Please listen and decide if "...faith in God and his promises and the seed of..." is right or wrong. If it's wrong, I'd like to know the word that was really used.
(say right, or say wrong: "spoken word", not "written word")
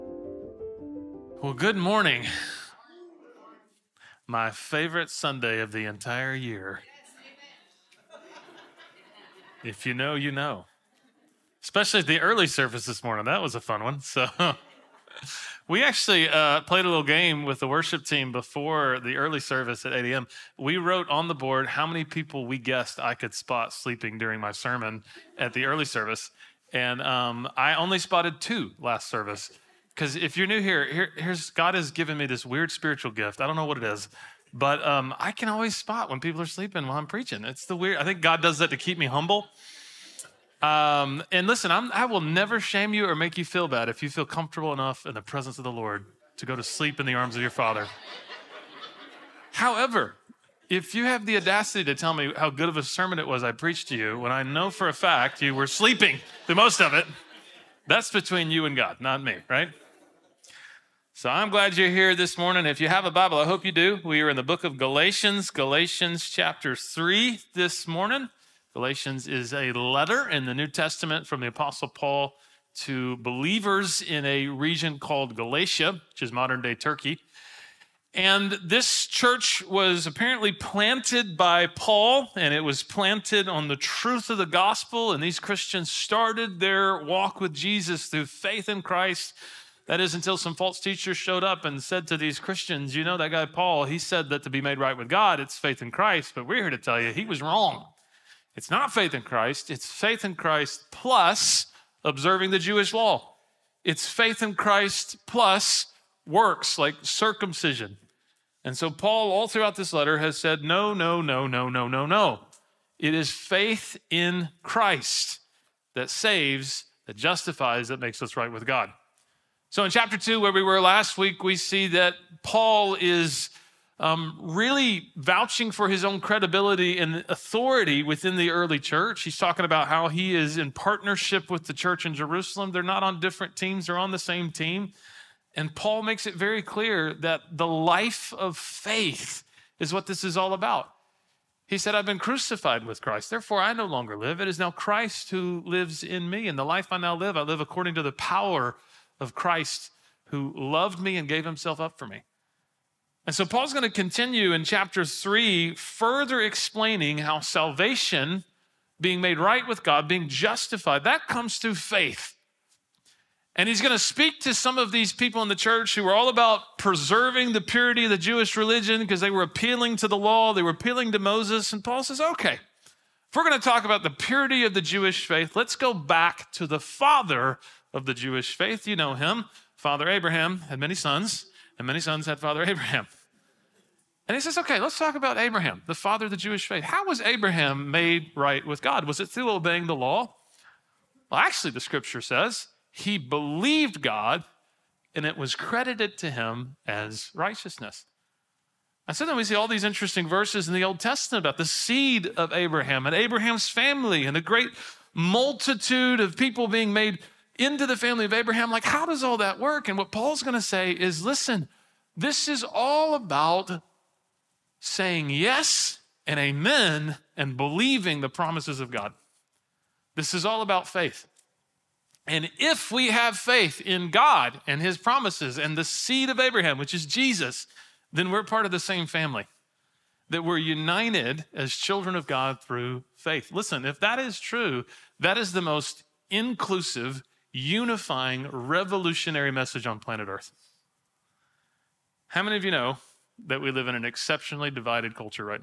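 right.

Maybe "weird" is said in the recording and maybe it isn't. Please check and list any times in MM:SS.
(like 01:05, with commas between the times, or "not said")
00:32, 00:37.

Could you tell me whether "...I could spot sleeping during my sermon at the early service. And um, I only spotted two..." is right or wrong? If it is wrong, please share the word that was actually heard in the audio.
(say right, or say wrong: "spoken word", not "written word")
right.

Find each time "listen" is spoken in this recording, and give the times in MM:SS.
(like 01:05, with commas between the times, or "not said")
00:41, 03:31, 03:53.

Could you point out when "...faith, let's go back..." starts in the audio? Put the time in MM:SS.
02:55.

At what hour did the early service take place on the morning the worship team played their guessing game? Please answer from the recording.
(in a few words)
8 a.m.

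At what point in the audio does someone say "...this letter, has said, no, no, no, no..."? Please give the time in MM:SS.
01:49.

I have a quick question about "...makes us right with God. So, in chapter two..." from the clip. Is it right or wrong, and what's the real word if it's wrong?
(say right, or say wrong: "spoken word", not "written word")
right.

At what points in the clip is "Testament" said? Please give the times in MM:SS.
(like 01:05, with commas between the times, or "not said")
01:10, 03:20.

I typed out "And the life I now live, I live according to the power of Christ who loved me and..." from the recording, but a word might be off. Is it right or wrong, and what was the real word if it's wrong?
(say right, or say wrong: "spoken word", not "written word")
right.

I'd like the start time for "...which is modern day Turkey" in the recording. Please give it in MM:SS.
01:16.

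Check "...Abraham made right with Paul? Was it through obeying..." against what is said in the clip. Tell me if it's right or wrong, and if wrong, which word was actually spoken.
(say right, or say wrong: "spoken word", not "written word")
wrong: "God", not "Paul".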